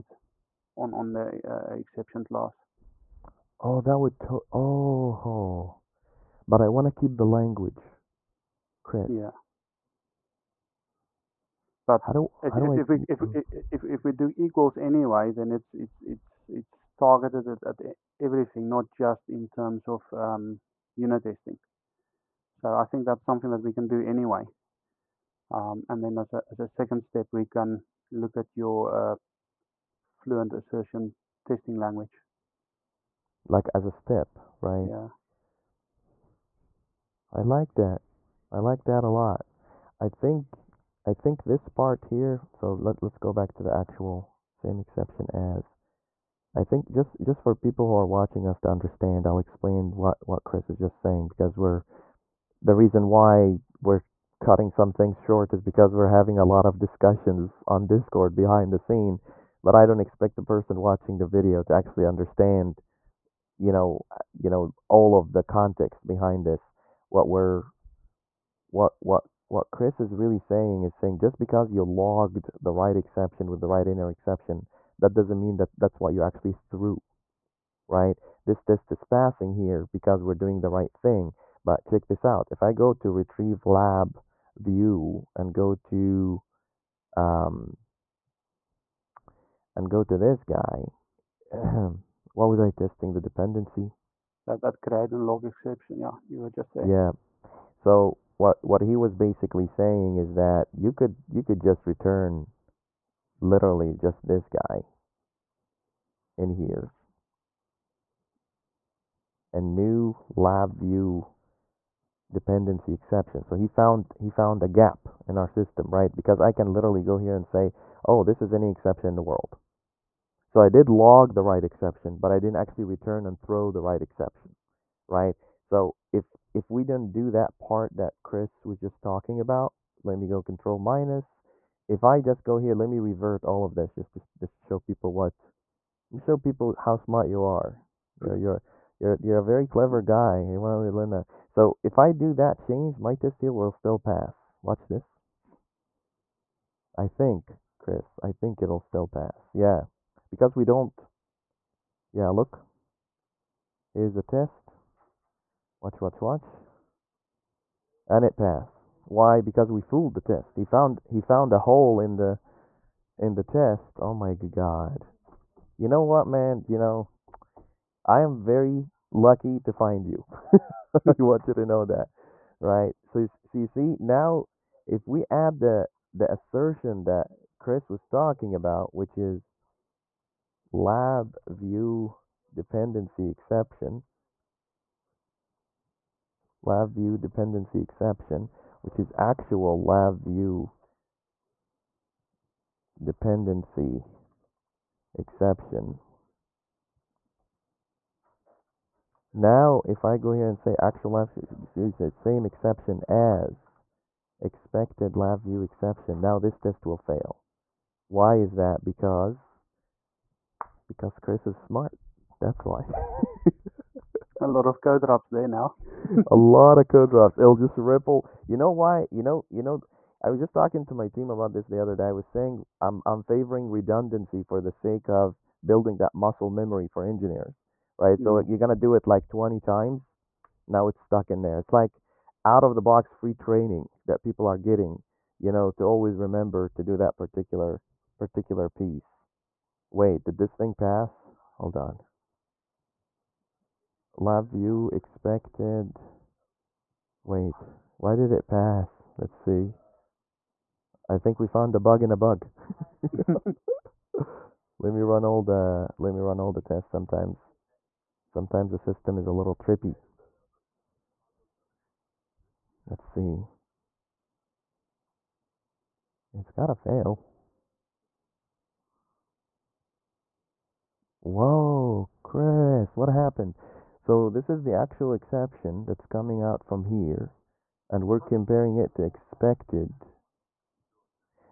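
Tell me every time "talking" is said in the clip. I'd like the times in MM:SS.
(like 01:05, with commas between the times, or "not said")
02:09, 02:58, 03:40.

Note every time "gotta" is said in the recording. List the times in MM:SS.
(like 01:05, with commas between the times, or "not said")
04:26.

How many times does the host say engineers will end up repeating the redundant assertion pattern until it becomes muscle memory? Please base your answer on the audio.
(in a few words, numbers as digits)
20.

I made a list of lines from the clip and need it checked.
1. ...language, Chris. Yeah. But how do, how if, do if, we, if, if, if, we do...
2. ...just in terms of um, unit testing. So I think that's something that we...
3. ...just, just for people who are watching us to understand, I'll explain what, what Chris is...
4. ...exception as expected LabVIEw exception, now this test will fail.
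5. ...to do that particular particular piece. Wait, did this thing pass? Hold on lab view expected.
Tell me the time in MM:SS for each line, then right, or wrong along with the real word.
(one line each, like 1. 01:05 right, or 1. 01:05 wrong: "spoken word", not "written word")
1. 00:07 right
2. 00:18 right
3. 00:46 right
4. 03:22 right
5. 03:56 right.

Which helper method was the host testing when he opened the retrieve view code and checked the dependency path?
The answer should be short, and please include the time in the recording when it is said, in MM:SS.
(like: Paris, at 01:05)
create and log exception, at 01:34.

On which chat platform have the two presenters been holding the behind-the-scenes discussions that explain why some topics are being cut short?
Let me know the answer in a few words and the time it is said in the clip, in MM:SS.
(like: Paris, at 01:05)
Discord, at 00:57.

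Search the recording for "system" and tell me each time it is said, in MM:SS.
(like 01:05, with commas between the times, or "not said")
01:55, 04:18.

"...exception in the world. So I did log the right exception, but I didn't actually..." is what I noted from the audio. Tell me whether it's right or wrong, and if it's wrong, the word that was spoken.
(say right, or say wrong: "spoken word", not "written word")
right.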